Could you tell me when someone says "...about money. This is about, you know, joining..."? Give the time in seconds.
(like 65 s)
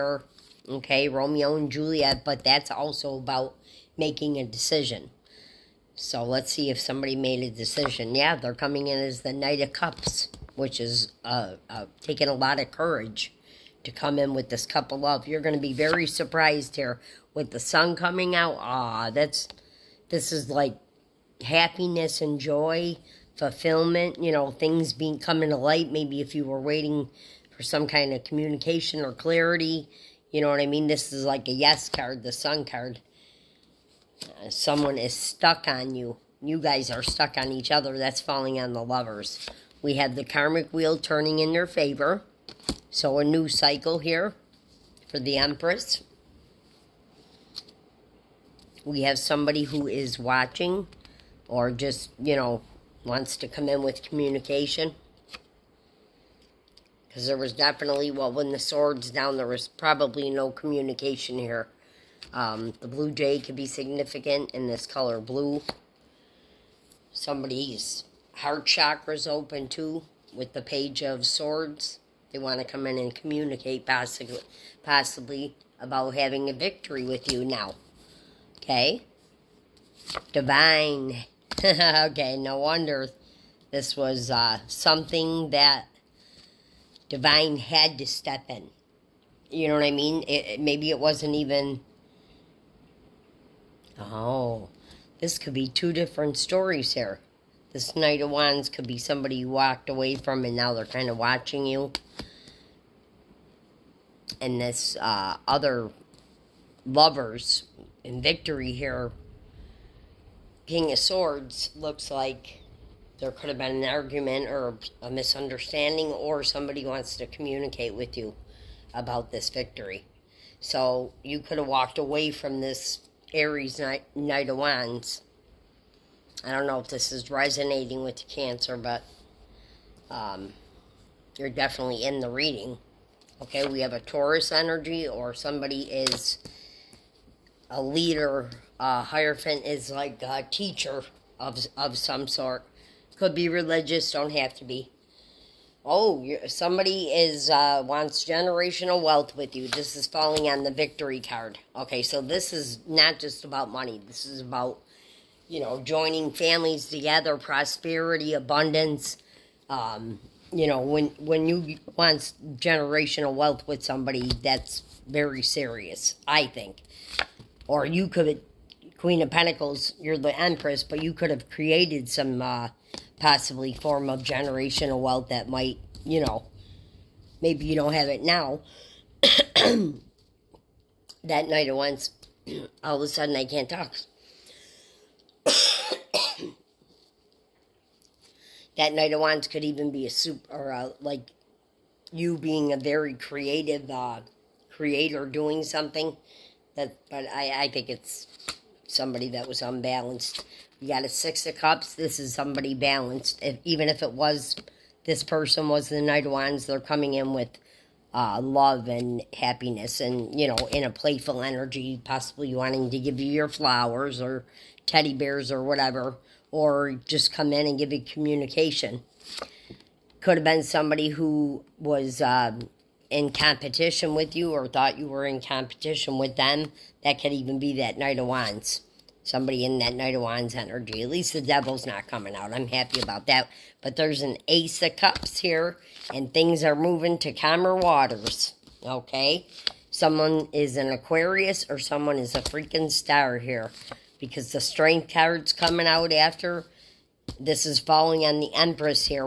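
153 s.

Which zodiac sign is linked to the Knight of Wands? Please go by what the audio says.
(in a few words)
Aries.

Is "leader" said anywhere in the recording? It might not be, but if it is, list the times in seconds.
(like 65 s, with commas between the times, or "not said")
137 s.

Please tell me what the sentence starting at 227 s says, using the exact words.
That could even be that Knight of Wands.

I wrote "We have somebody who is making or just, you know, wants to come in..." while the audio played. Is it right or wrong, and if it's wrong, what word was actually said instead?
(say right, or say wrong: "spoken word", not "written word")
wrong: "watching", not "making".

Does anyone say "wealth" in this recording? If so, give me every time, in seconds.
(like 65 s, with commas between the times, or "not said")
149 s, 163 s, 175 s.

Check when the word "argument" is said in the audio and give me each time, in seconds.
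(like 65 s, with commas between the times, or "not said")
113 s.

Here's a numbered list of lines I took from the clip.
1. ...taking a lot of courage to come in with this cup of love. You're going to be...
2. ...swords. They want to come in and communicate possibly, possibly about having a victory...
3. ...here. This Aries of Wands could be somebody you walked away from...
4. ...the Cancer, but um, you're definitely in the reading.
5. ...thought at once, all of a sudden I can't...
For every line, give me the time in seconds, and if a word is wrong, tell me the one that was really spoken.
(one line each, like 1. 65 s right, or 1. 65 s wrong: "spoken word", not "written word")
1. 12 s right
2. 71 s right
3. 96 s wrong: "Knight", not "Aries"
4. 128 s right
5. 181 s wrong: "night", not "thought".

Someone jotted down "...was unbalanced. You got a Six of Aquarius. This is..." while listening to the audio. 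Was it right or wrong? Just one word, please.
wrong.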